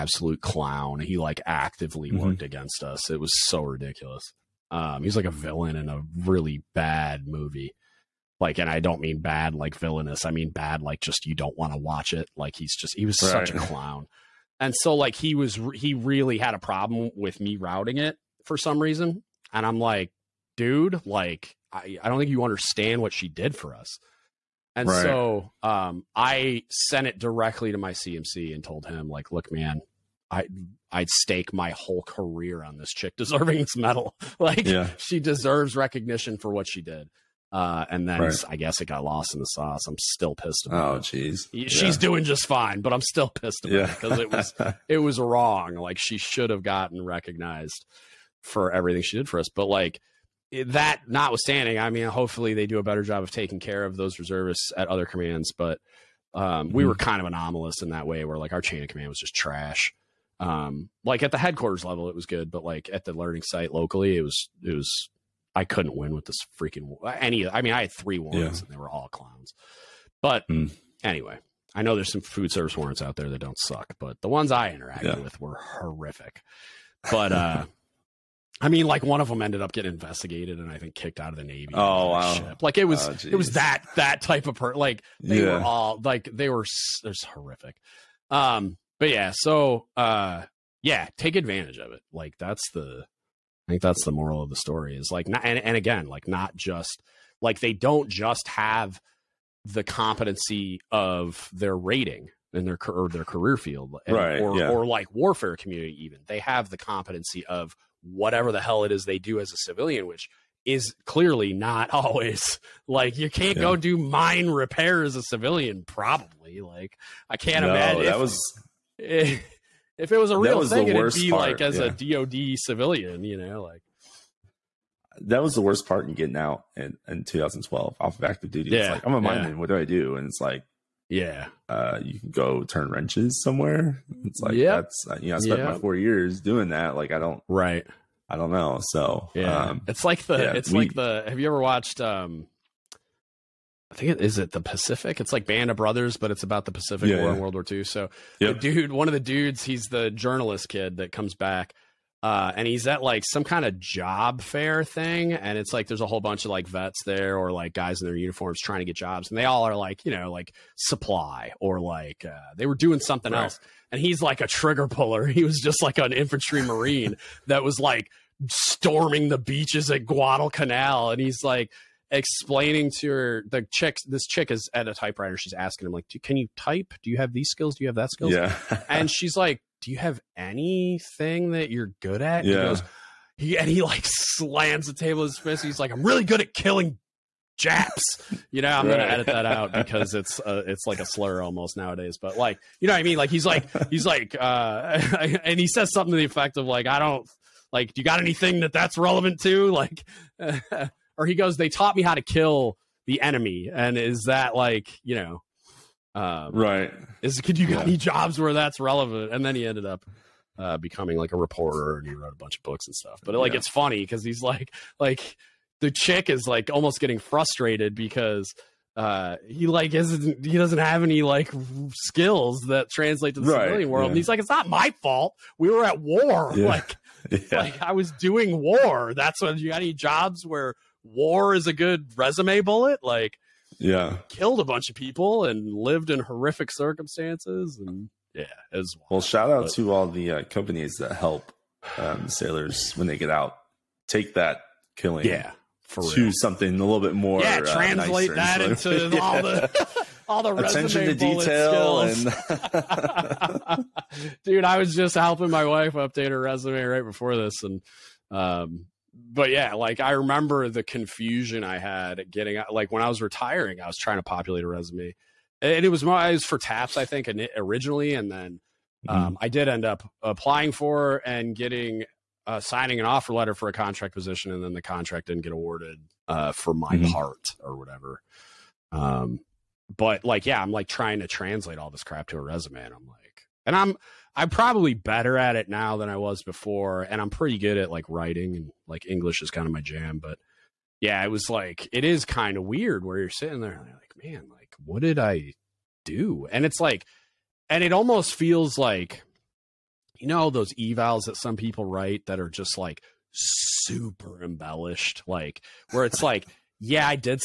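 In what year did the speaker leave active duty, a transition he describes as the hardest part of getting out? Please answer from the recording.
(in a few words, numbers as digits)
2012.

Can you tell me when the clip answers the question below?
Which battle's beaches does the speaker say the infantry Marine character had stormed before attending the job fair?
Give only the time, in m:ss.
2:50.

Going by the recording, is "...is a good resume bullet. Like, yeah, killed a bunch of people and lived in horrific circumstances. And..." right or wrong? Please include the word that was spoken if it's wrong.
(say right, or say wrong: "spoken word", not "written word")
right.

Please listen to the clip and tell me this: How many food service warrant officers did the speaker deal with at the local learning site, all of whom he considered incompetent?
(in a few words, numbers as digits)
3.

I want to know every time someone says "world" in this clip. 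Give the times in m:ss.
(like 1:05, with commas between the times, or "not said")
2:27, 3:43.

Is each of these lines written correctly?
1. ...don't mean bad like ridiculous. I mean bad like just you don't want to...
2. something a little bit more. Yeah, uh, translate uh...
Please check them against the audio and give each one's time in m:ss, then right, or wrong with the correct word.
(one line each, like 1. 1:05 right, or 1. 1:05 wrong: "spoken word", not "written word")
1. 0:08 wrong: "villainous", not "ridiculous"
2. 4:06 right.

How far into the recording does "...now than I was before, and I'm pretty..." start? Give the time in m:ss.
4:45.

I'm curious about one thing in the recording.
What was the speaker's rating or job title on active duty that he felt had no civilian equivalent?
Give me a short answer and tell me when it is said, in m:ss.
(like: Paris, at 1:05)
Mineman, at 2:09.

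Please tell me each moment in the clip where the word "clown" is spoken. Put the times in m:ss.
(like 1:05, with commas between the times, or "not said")
0:00, 0:13, 1:09.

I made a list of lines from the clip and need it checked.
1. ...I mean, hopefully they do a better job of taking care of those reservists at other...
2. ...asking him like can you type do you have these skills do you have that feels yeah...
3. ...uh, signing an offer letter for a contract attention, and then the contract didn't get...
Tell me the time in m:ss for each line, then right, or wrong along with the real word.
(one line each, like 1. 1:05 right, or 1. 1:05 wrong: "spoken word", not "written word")
1. 0:51 right
2. 2:55 wrong: "skills", not "feels"
3. 4:32 wrong: "position", not "attention".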